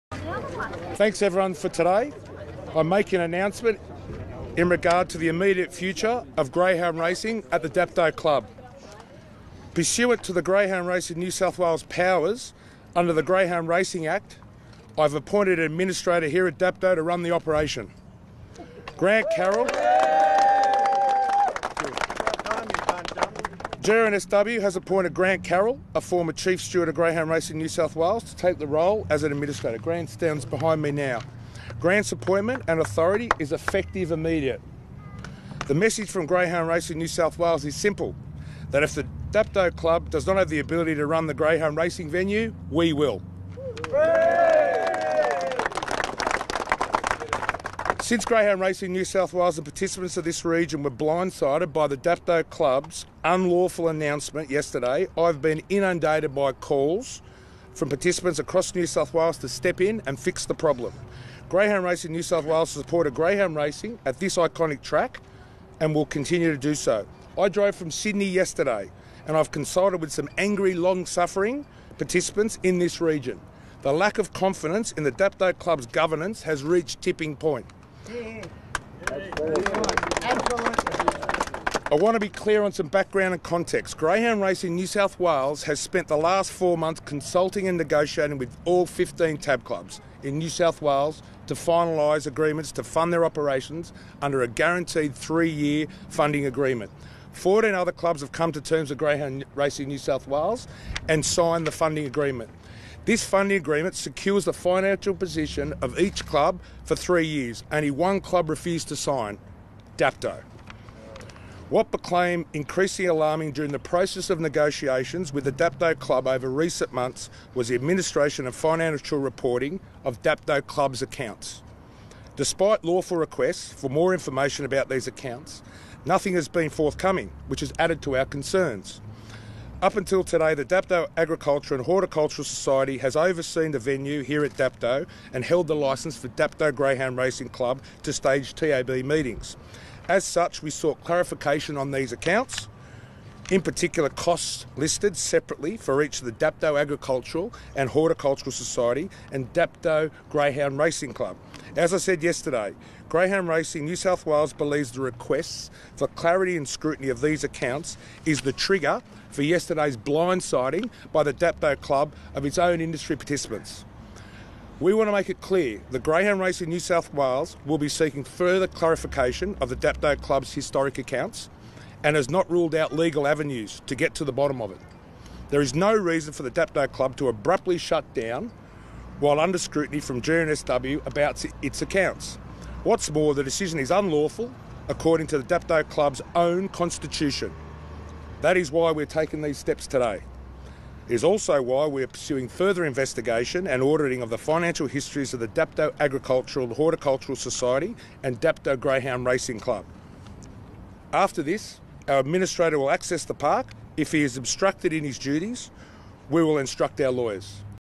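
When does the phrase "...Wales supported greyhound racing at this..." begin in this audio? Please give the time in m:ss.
1:02.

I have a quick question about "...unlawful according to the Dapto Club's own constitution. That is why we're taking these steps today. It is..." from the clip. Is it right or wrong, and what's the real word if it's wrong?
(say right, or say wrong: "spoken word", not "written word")
right.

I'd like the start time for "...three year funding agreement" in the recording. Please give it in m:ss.
1:35.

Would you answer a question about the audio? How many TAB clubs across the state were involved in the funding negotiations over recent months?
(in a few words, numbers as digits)
15.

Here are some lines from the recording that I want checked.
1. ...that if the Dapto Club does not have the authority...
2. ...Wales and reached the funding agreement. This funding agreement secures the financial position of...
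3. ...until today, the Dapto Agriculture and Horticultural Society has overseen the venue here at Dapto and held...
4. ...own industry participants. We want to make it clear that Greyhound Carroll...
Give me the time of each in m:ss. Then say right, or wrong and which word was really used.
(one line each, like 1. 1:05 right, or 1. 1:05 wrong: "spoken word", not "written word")
1. 0:38 wrong: "ability", not "authority"
2. 1:40 wrong: "signed", not "reached"
3. 2:09 right
4. 2:42 wrong: "Racing", not "Carroll".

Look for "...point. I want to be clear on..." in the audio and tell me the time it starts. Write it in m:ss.
1:17.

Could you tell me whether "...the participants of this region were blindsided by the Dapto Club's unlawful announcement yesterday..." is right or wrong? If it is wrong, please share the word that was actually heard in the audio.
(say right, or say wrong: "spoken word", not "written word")
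right.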